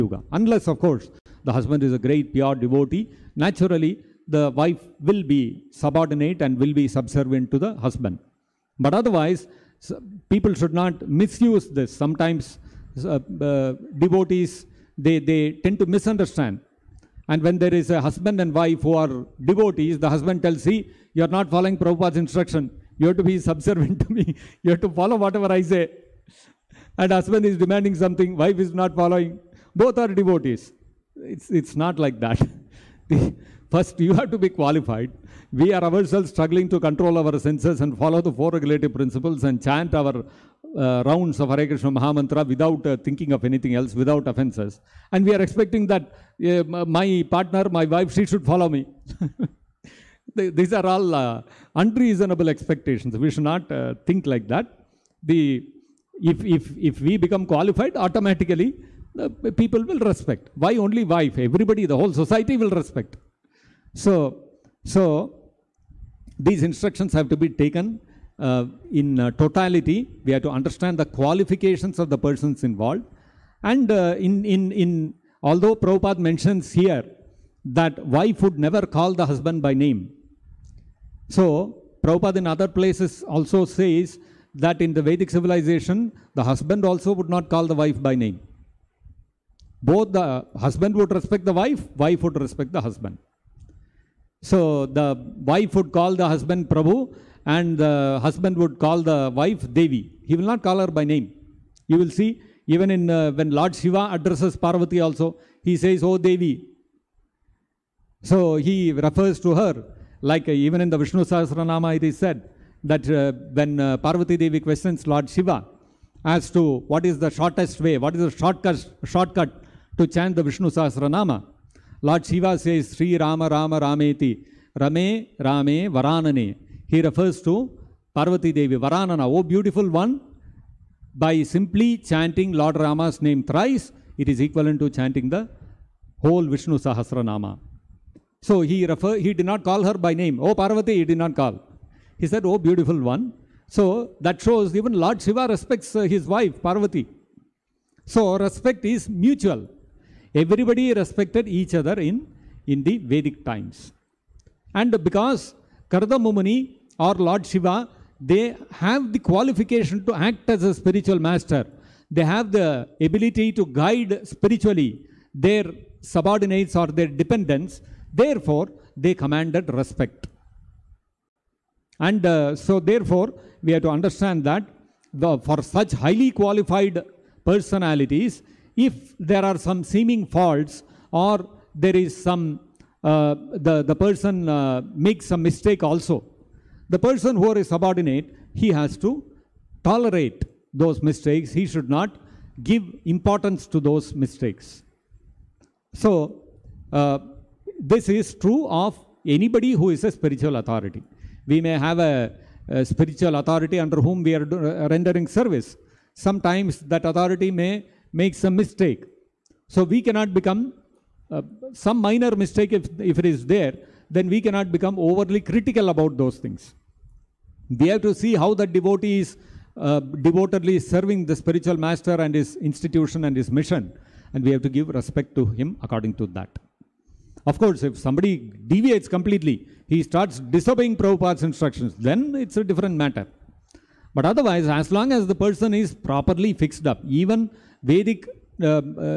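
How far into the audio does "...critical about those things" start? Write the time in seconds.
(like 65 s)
215 s.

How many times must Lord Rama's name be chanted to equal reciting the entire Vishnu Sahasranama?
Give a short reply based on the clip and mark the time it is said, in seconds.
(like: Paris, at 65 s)
thrice, at 133 s.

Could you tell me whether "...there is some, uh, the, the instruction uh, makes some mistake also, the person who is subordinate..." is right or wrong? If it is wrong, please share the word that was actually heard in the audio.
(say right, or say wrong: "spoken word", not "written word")
wrong: "person", not "instruction".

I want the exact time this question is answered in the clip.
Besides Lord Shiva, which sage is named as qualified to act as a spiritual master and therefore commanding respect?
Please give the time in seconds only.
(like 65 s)
155 s.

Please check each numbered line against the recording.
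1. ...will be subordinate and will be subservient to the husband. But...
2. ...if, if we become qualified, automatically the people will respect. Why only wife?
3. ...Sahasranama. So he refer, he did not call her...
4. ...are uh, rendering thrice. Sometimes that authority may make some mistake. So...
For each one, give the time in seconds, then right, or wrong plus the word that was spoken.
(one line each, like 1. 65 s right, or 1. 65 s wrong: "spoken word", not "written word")
1. 5 s right
2. 56 s right
3. 136 s right
4. 204 s wrong: "service", not "thrice".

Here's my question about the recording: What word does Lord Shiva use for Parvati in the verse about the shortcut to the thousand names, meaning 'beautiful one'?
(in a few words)
Varanana.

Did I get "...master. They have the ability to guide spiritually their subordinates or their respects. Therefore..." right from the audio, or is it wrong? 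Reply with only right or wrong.
wrong.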